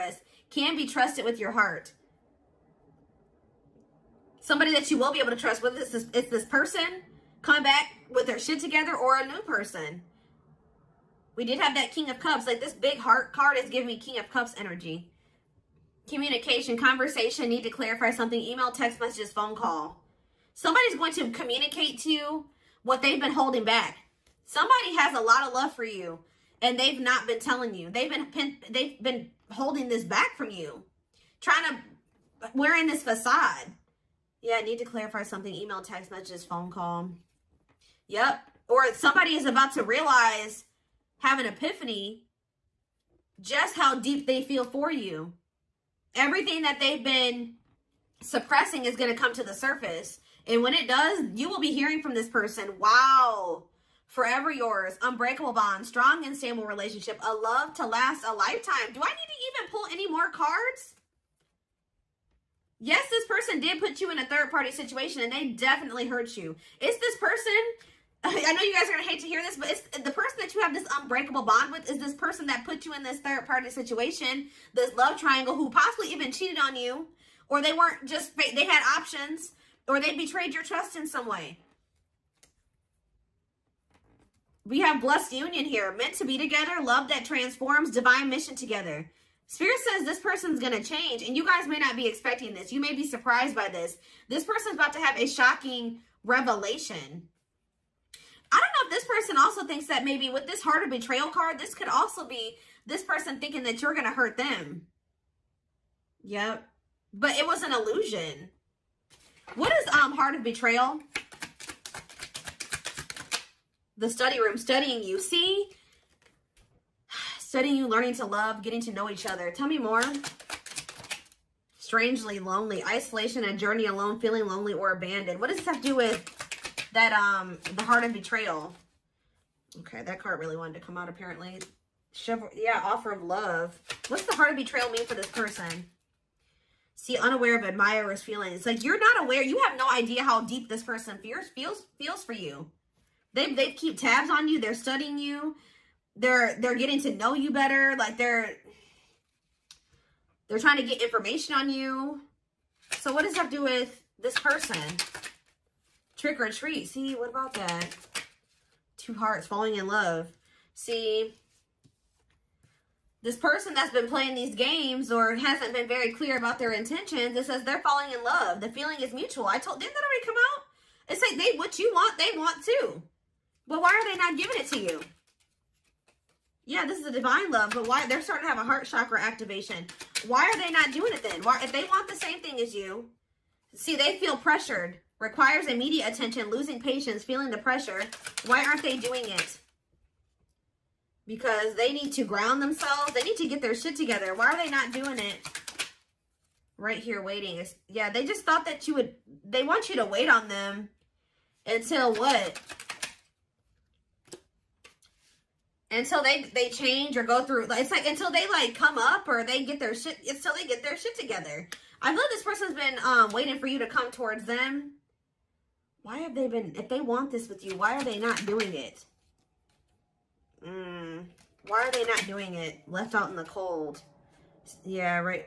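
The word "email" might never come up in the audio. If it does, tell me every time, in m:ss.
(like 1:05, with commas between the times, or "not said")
0:18, 0:35.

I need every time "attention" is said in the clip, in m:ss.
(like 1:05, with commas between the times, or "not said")
3:06.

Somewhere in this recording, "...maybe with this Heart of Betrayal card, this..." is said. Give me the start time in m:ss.
1:40.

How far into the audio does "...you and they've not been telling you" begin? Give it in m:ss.
0:25.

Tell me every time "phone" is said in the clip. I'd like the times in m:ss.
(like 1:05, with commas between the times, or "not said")
0:19, 0:36.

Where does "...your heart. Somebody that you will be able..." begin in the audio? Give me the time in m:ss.
0:01.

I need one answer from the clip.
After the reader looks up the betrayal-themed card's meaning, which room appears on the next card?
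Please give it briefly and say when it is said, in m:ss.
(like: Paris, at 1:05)
The study room, at 1:53.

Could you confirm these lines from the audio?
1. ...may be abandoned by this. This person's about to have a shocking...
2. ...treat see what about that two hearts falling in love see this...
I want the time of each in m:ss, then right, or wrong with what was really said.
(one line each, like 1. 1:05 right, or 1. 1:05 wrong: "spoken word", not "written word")
1. 1:32 wrong: "surprised", not "abandoned"
2. 2:36 right.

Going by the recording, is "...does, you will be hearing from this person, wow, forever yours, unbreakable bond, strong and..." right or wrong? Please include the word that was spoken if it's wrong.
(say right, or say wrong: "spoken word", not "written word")
right.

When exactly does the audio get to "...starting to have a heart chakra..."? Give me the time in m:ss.
2:58.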